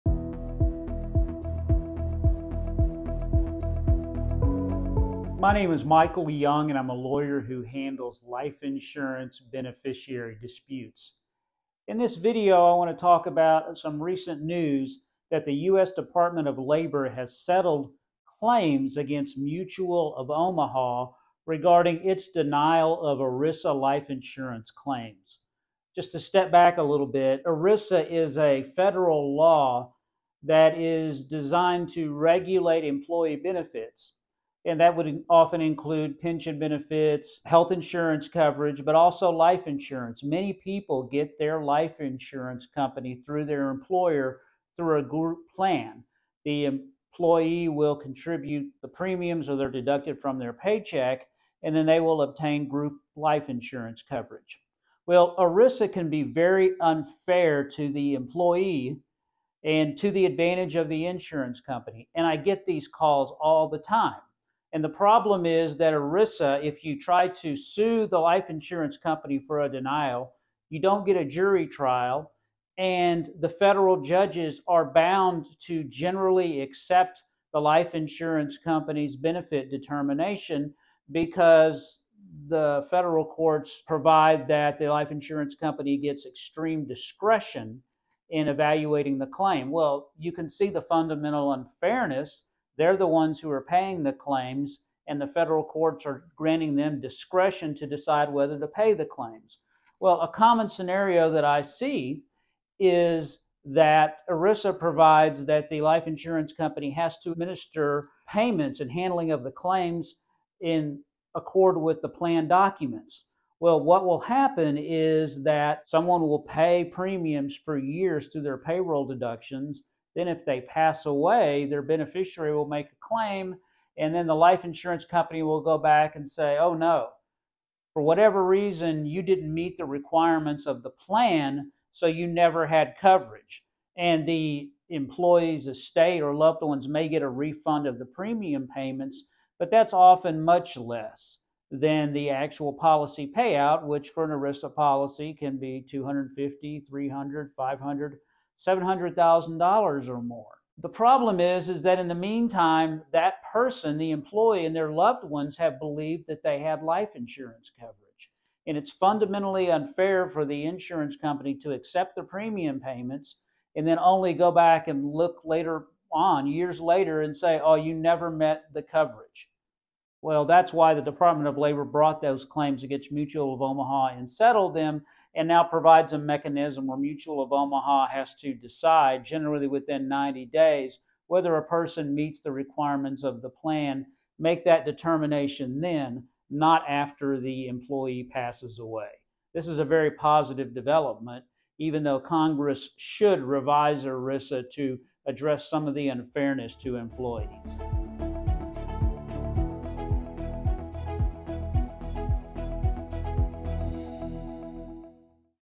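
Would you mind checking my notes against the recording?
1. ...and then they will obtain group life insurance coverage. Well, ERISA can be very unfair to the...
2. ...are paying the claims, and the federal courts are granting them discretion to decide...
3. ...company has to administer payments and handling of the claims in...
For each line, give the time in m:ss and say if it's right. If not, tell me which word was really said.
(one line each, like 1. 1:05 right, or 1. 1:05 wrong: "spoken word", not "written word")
1. 0:51 right
2. 1:33 right
3. 1:46 right.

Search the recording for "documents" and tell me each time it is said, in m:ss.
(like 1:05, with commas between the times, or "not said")
1:52.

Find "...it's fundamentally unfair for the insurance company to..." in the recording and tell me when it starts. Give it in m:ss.
2:38.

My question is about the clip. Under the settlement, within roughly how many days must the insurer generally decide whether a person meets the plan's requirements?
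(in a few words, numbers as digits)
90 days.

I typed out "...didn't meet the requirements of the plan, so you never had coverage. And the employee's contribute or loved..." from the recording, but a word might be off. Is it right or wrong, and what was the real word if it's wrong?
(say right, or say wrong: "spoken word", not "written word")
wrong: "estate", not "contribute".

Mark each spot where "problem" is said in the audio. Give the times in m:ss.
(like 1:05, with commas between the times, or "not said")
1:04, 2:30.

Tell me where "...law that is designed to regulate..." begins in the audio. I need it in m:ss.
0:29.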